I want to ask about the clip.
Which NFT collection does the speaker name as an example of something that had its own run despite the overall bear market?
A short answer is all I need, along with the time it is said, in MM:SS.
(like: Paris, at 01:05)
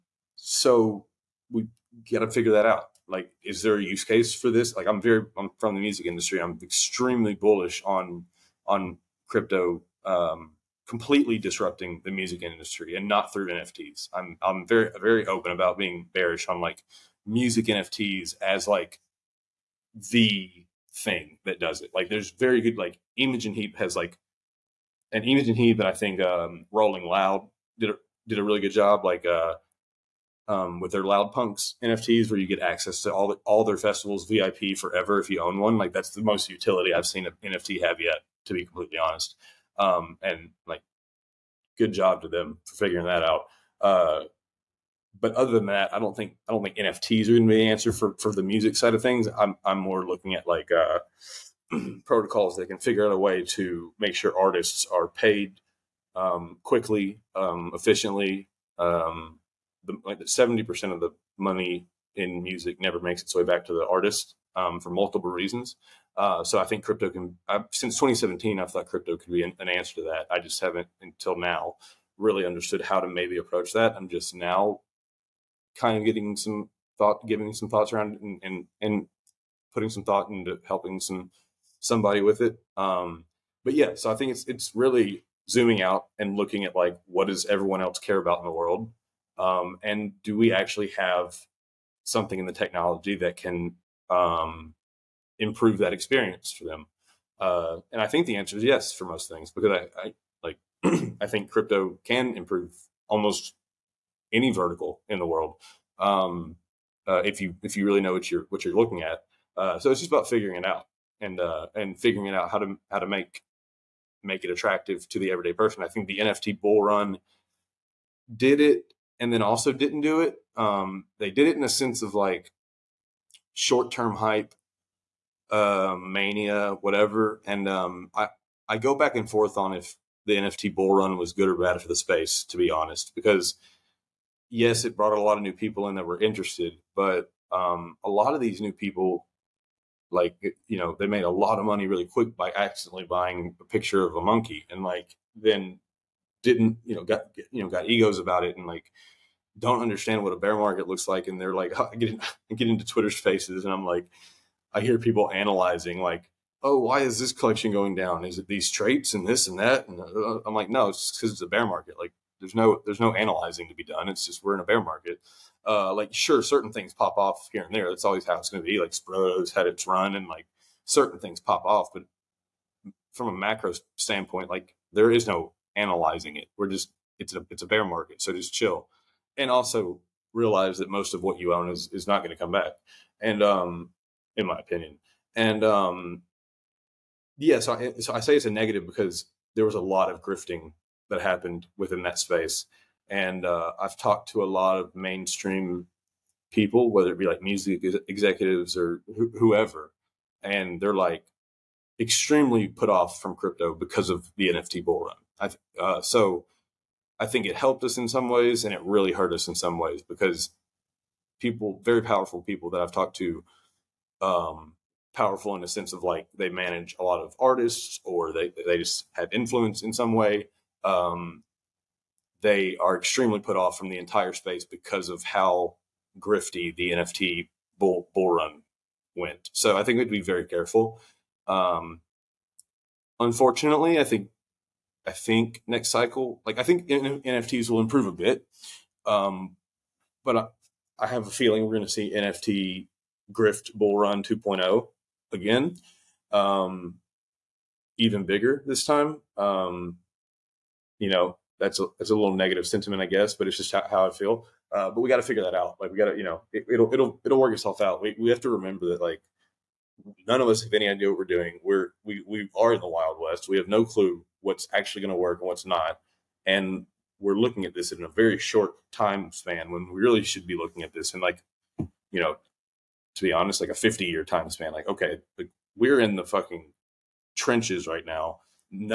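Sprotos, at 02:48.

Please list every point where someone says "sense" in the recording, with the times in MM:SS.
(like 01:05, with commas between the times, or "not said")
02:01, 03:35.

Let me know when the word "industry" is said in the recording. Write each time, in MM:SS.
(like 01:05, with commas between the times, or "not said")
00:06, 00:12.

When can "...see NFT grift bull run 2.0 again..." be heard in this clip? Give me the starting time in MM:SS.
04:01.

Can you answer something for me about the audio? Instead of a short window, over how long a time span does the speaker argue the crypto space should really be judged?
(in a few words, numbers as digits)
50 years.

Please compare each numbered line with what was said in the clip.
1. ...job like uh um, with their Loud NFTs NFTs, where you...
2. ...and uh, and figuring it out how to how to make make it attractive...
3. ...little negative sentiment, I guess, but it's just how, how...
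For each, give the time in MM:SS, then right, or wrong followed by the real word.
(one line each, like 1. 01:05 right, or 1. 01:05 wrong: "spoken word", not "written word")
1. 00:28 wrong: "Punks", not "NFTs"
2. 01:51 right
3. 04:12 right.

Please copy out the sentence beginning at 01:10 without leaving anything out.
I just haven't until now really understood how to maybe approach that.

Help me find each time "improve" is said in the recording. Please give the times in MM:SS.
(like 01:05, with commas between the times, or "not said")
01:35, 01:42, 03:57.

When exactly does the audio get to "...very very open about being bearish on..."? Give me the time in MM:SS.
00:14.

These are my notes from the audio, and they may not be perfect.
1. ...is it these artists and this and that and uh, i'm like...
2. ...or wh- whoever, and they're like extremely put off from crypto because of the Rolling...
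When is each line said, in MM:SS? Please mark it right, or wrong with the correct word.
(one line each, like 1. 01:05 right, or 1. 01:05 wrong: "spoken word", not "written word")
1. 02:38 wrong: "traits", not "artists"
2. 03:18 wrong: "NFT", not "Rolling".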